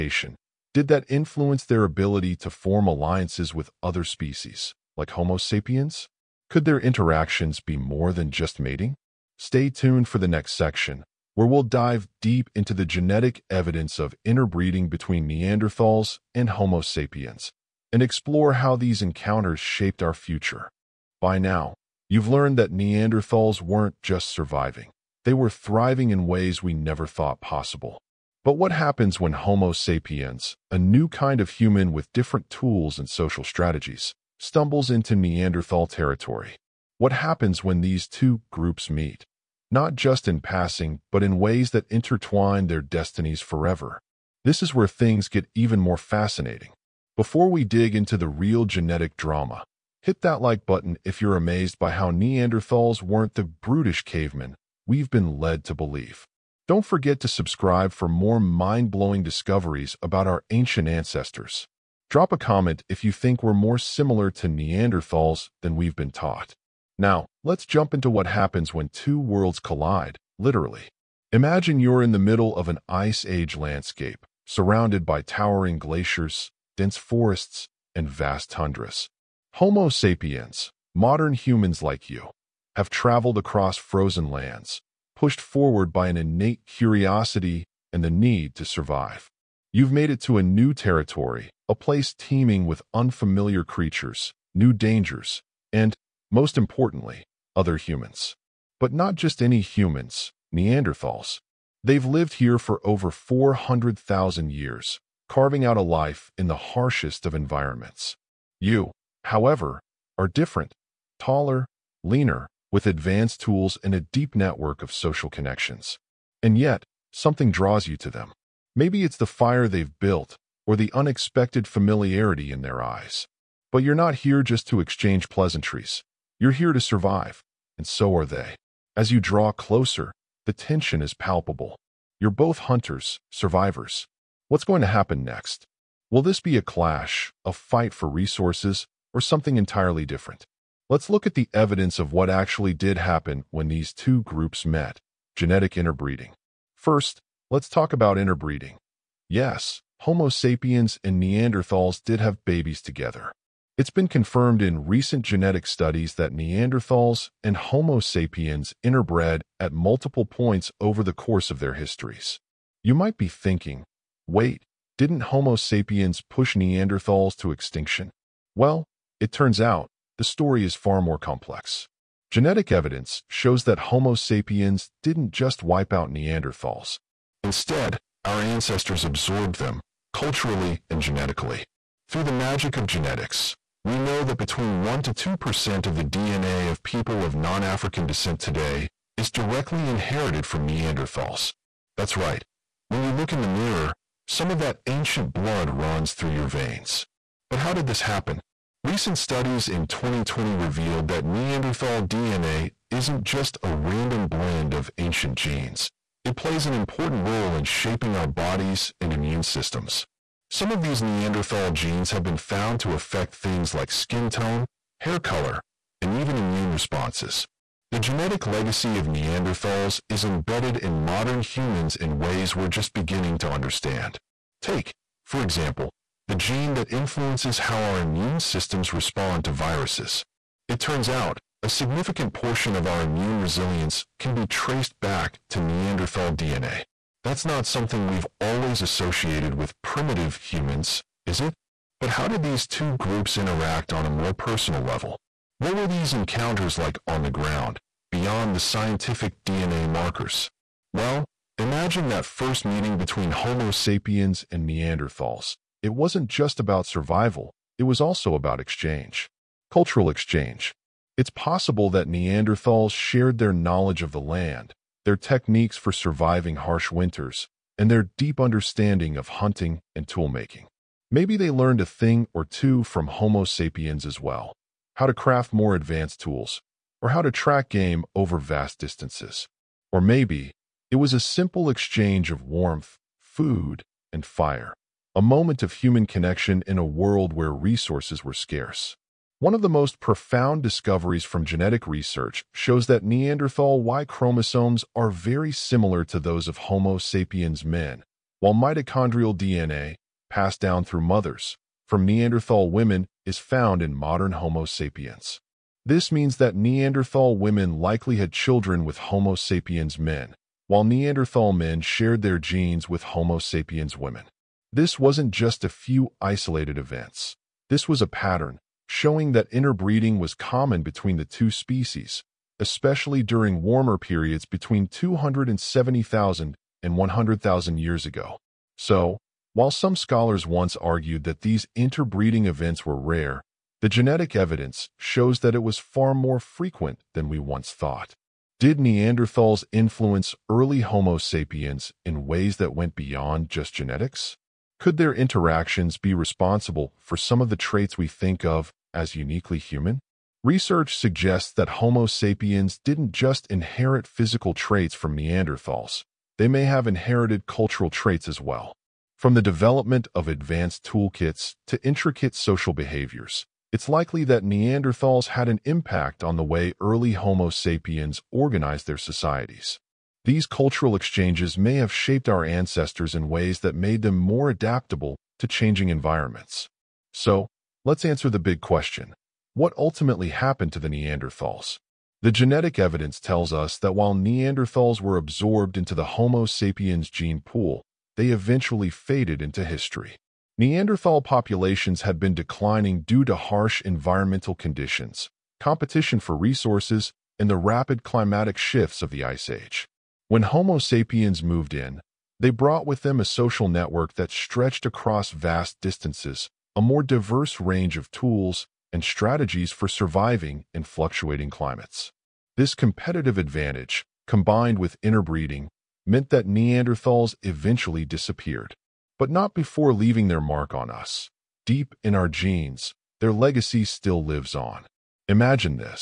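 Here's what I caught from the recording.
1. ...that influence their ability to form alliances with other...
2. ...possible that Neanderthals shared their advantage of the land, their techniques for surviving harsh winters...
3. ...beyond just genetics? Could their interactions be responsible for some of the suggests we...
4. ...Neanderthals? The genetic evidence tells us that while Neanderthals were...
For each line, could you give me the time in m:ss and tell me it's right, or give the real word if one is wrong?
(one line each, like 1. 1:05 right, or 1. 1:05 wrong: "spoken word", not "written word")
1. 0:00 right
2. 4:21 wrong: "knowledge", not "advantage"
3. 5:42 wrong: "traits", not "suggests"
4. 6:20 right.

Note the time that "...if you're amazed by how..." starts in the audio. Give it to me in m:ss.
0:51.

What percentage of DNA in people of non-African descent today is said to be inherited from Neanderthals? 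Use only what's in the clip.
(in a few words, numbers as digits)
1 to 2%.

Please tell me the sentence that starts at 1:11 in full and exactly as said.
Imagine you're in the middle of an ice age landscape, surrounded by towering glaciers, dense forests, and vast tundras.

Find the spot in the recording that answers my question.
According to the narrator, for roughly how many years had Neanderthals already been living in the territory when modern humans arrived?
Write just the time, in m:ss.
1:42.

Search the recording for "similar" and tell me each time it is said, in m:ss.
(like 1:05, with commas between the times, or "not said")
1:03, 4:55.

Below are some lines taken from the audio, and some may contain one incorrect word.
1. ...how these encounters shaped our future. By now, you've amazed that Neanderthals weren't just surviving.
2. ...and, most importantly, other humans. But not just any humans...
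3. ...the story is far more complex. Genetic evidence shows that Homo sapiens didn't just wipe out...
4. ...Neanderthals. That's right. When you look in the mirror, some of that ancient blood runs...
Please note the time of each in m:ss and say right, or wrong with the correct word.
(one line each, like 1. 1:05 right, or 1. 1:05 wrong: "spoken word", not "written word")
1. 0:18 wrong: "learned", not "amazed"
2. 1:35 right
3. 2:50 right
4. 3:10 right.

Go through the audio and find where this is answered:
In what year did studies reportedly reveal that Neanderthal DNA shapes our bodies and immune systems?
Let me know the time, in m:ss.
3:19.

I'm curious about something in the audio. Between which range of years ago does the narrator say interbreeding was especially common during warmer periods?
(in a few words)
270,000 to 100,000 years ago.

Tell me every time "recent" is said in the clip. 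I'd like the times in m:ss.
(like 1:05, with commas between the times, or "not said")
2:34, 3:18.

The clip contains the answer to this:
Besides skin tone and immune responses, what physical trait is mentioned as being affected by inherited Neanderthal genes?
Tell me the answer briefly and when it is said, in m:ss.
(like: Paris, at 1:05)
Hair color, at 3:35.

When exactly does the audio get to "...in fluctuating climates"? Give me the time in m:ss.
6:50.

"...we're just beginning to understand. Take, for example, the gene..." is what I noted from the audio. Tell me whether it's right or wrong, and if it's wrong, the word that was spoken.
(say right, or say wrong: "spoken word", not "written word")
right.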